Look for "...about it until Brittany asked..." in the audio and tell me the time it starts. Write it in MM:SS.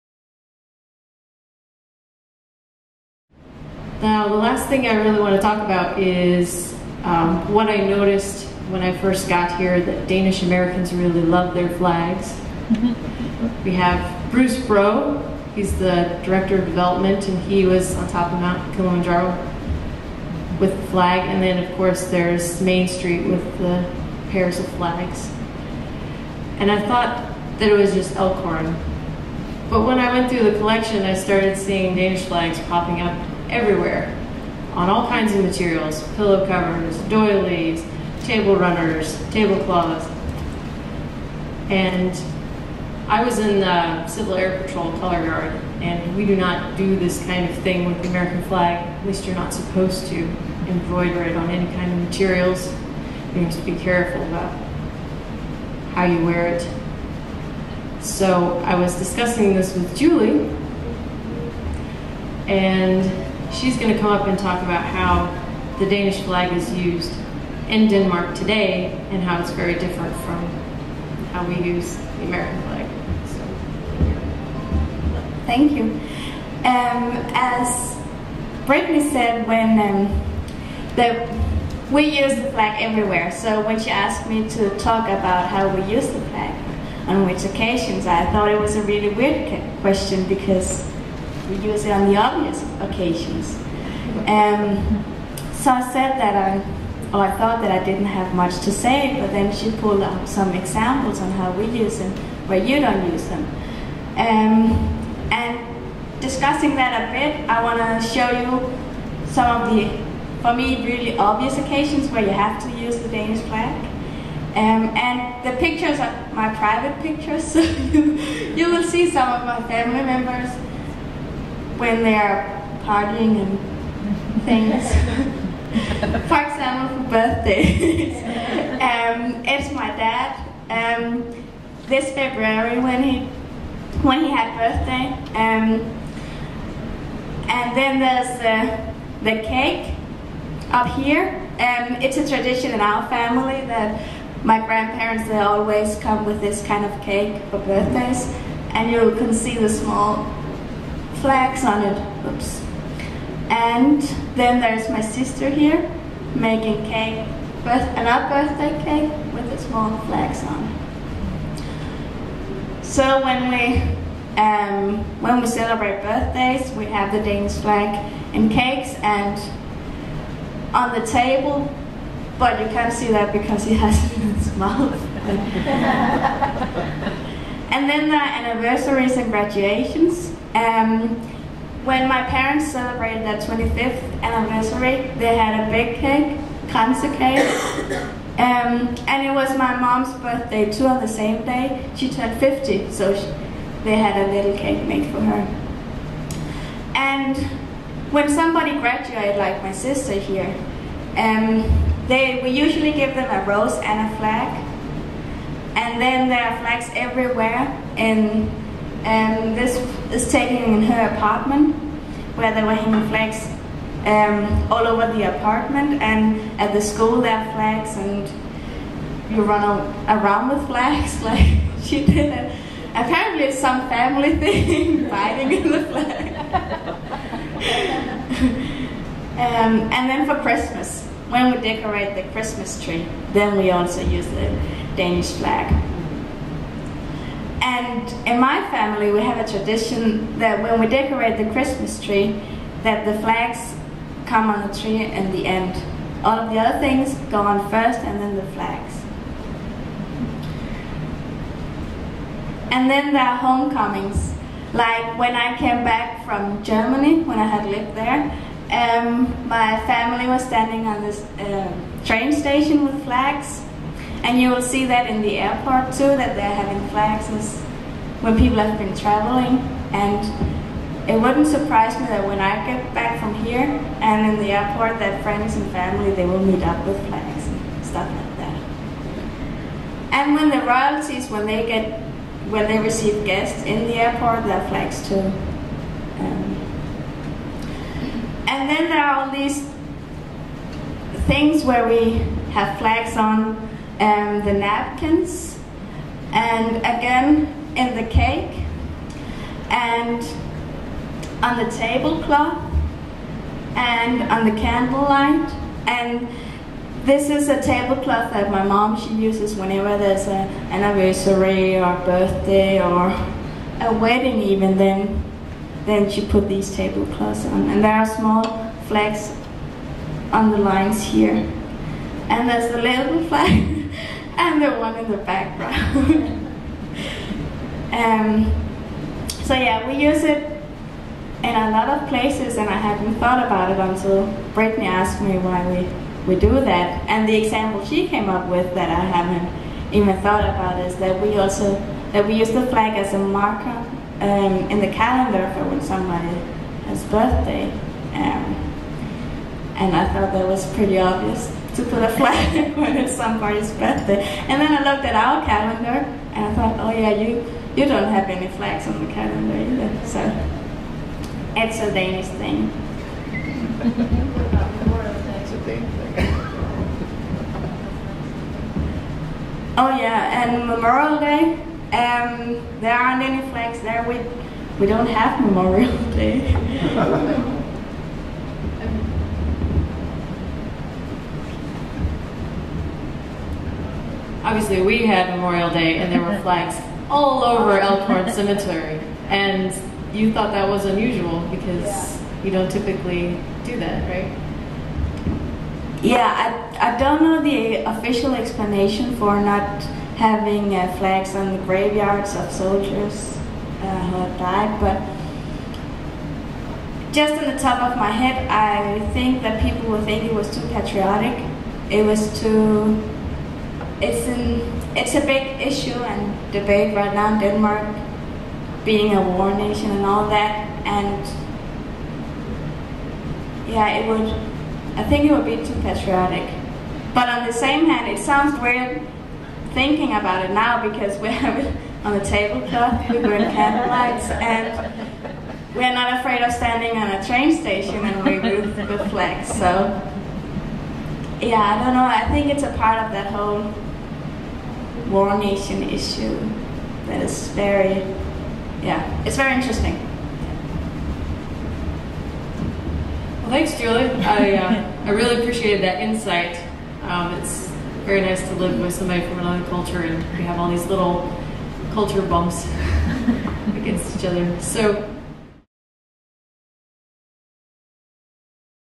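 05:33.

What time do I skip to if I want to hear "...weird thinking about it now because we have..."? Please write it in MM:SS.
07:08.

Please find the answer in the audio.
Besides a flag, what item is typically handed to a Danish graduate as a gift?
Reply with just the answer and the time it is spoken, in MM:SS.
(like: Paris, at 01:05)
A rose, at 03:23.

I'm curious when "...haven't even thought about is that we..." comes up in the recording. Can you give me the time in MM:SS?
05:39.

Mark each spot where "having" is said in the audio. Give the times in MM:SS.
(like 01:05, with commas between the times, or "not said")
04:26, 06:40.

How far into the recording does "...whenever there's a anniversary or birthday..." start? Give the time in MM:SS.
05:09.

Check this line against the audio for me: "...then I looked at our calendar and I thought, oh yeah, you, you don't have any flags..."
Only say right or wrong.
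right.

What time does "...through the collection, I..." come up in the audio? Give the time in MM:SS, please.
00:30.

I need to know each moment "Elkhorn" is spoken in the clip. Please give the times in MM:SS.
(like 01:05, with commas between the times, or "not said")
00:28, 06:27.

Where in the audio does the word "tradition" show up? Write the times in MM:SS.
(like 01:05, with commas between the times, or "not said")
02:22, 03:59.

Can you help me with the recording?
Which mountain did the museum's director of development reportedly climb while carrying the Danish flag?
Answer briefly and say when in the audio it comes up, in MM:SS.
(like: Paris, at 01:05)
Mount Kilimanjaro, at 00:18.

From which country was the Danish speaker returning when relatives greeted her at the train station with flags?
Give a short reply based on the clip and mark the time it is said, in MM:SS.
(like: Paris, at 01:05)
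Germany, at 04:16.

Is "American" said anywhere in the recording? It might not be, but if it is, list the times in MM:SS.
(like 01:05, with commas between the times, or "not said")
00:10, 00:48, 01:12.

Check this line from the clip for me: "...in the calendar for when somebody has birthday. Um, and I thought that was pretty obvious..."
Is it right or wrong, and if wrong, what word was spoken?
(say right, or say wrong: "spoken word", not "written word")
right.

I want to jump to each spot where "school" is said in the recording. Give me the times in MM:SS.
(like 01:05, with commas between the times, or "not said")
03:36.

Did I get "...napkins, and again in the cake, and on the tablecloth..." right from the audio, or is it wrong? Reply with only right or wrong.
right.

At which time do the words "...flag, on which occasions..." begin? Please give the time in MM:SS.
01:26.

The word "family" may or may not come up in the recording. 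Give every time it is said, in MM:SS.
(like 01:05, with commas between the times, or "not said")
01:59, 02:23, 03:43, 03:58, 04:19, 04:35.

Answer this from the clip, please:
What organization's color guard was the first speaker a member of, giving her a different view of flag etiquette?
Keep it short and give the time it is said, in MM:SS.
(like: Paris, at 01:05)
Civil Air Patrol, at 00:44.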